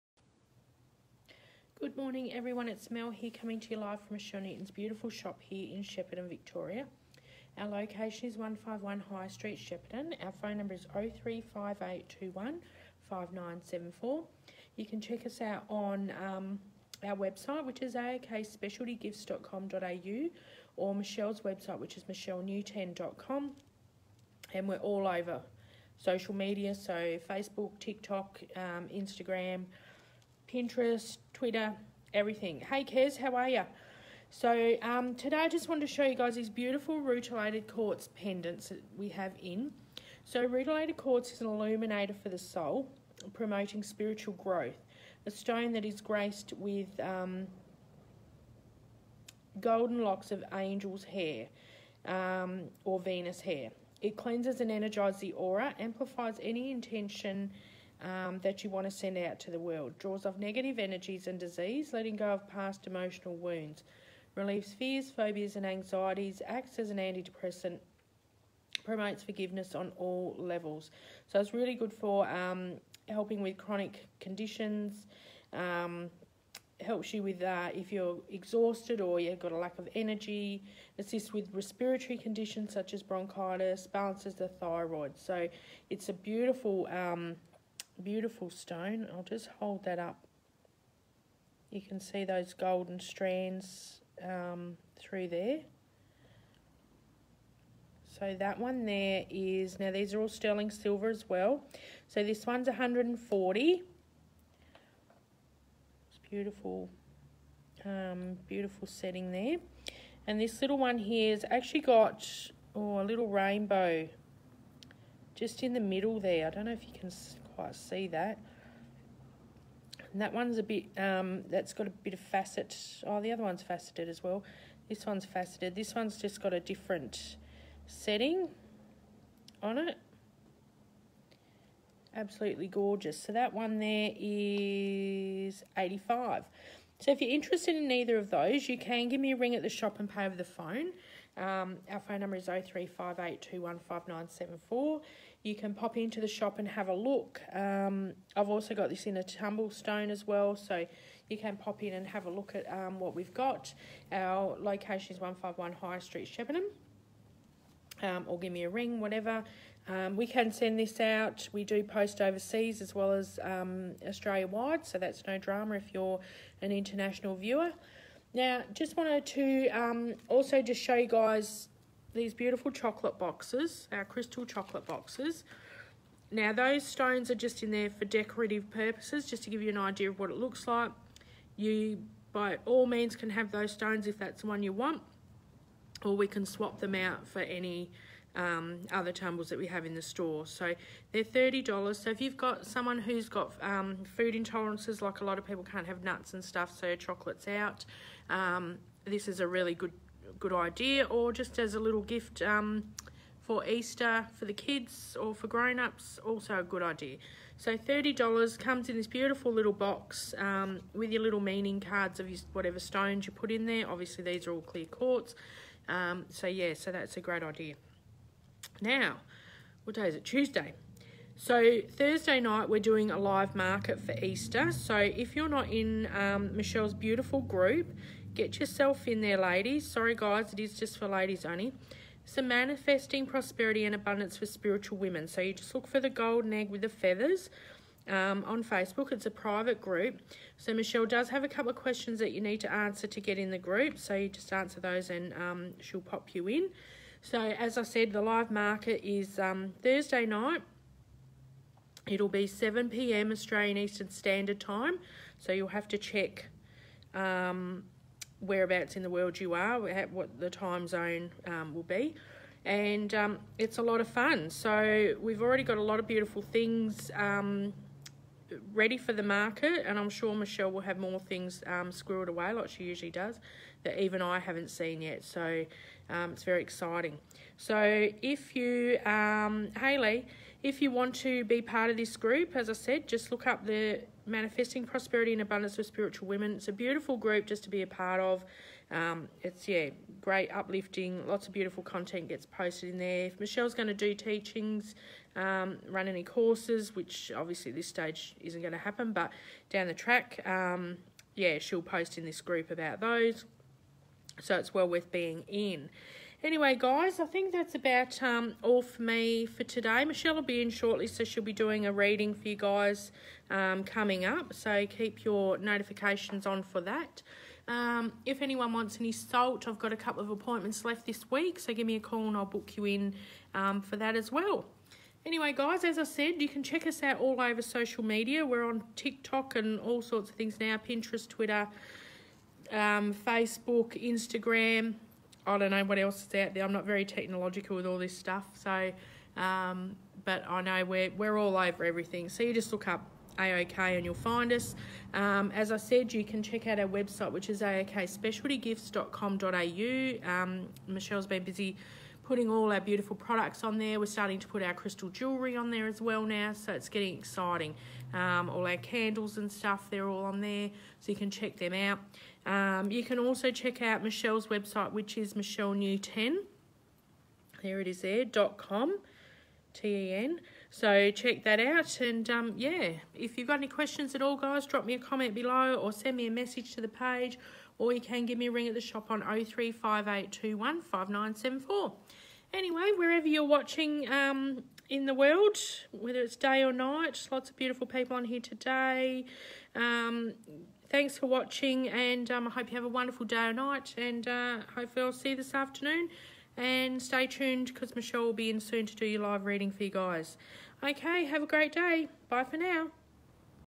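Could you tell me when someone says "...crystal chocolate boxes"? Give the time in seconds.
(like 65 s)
174 s.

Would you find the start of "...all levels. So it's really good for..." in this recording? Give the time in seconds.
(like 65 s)
69 s.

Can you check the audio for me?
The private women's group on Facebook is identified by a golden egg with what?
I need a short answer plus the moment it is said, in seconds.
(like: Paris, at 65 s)
feathers, at 236 s.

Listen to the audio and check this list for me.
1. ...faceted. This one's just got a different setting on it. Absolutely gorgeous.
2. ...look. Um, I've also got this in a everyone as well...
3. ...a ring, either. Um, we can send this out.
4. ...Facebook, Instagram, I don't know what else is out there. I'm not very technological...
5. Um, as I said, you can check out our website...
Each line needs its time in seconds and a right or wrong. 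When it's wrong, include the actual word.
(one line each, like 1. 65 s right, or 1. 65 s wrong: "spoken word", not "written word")
1. 125 s right
2. 146 s wrong: "tumblestone", not "everyone"
3. 158 s wrong: "whatever", not "either"
4. 333 s right
5. 345 s right.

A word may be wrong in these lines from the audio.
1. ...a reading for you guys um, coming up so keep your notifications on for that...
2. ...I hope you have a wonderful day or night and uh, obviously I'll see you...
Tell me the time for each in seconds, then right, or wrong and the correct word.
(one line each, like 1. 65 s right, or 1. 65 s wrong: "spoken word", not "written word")
1. 311 s right
2. 392 s wrong: "hopefully", not "obviously".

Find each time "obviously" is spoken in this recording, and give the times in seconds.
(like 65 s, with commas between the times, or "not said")
213 s, 297 s.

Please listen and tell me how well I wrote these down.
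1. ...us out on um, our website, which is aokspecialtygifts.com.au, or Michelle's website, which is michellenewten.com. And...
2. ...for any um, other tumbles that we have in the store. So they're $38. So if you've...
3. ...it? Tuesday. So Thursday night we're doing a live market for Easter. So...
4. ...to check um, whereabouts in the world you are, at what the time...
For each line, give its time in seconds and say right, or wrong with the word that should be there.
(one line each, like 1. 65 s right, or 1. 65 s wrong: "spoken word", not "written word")
1. 15 s right
2. 187 s wrong: "30", not "38"
3. 220 s right
4. 255 s right.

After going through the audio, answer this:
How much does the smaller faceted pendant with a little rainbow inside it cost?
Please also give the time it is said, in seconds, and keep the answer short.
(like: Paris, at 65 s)
85, at 135 s.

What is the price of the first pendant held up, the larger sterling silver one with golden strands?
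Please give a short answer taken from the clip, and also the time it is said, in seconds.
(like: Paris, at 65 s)
140, at 102 s.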